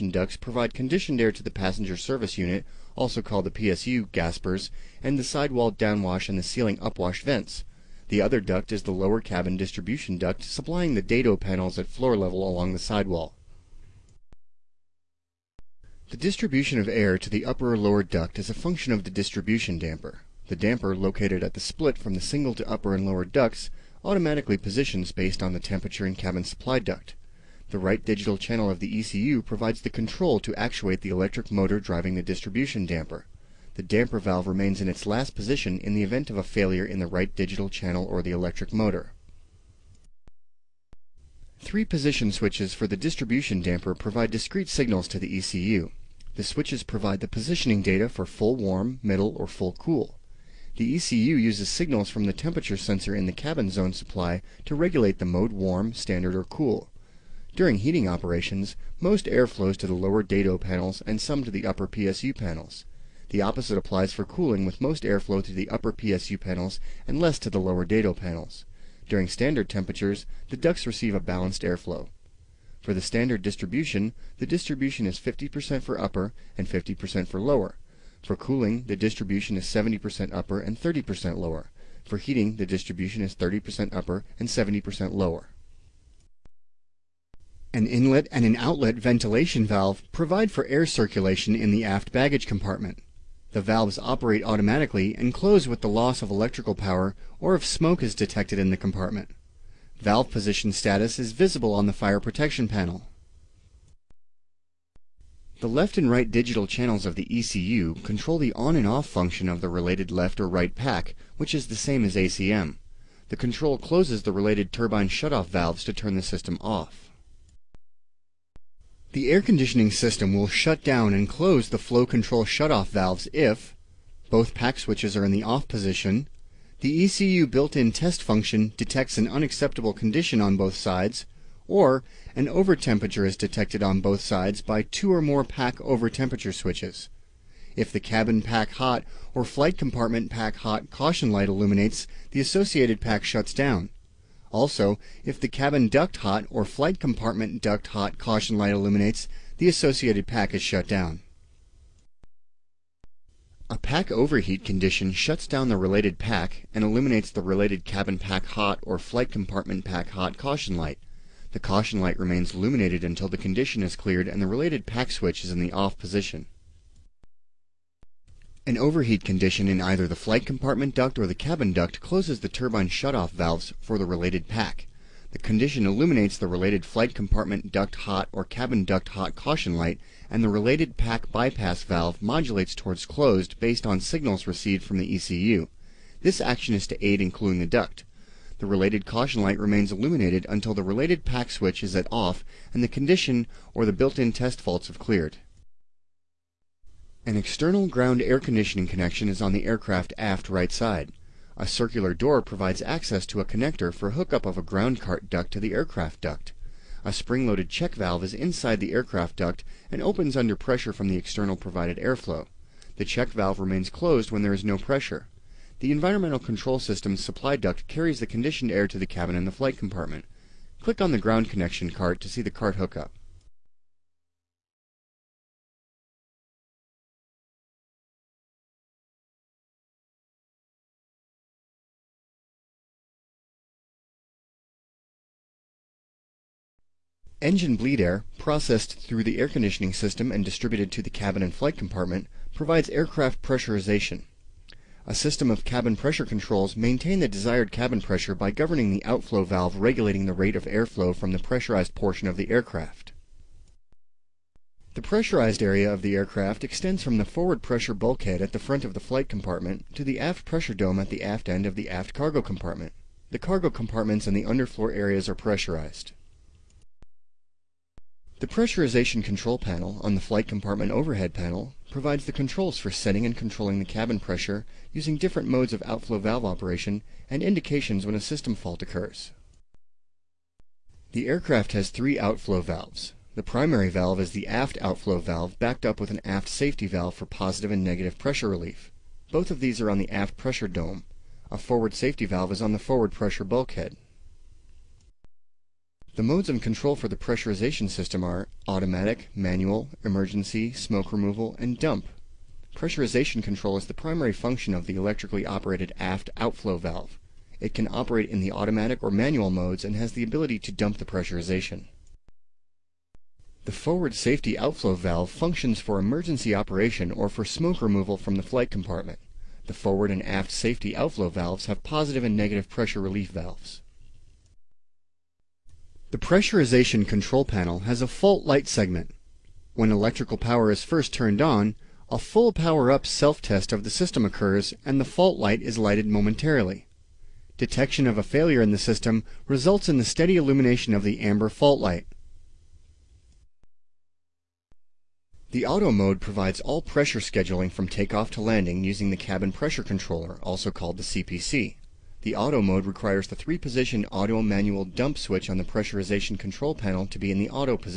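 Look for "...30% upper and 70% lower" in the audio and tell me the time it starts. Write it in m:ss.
1:23.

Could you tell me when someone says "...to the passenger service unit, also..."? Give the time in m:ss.
0:01.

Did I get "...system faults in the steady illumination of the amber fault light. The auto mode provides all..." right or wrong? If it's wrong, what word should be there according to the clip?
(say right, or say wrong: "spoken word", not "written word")
wrong: "results", not "faults".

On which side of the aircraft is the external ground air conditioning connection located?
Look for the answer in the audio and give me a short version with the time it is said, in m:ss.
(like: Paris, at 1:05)
Aft right side, at 3:20.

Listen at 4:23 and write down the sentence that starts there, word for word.
The cargo compartments and the underfloor areas are pressurized.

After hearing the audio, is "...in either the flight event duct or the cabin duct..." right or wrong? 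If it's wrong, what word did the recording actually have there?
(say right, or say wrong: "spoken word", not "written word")
wrong: "compartment", not "event".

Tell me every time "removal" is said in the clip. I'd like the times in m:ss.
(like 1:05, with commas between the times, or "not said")
5:01, 5:17.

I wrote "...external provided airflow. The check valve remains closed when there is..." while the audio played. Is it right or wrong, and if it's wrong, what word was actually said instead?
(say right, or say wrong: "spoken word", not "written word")
right.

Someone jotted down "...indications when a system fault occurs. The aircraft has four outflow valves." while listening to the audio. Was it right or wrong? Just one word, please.
wrong.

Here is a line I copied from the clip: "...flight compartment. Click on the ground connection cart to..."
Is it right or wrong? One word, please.
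right.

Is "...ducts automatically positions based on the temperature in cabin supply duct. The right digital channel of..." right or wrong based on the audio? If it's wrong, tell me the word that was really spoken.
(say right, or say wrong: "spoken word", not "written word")
right.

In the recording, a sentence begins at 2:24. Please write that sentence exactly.
Also, if the cabin duct hot or flight compartment duct hot caution light illuminates, the associated pack is shut down.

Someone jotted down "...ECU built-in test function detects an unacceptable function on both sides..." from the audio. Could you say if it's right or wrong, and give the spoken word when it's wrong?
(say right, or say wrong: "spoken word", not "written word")
wrong: "condition", not "function".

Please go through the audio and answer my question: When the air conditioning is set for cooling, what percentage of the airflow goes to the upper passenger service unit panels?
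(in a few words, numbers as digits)
70%.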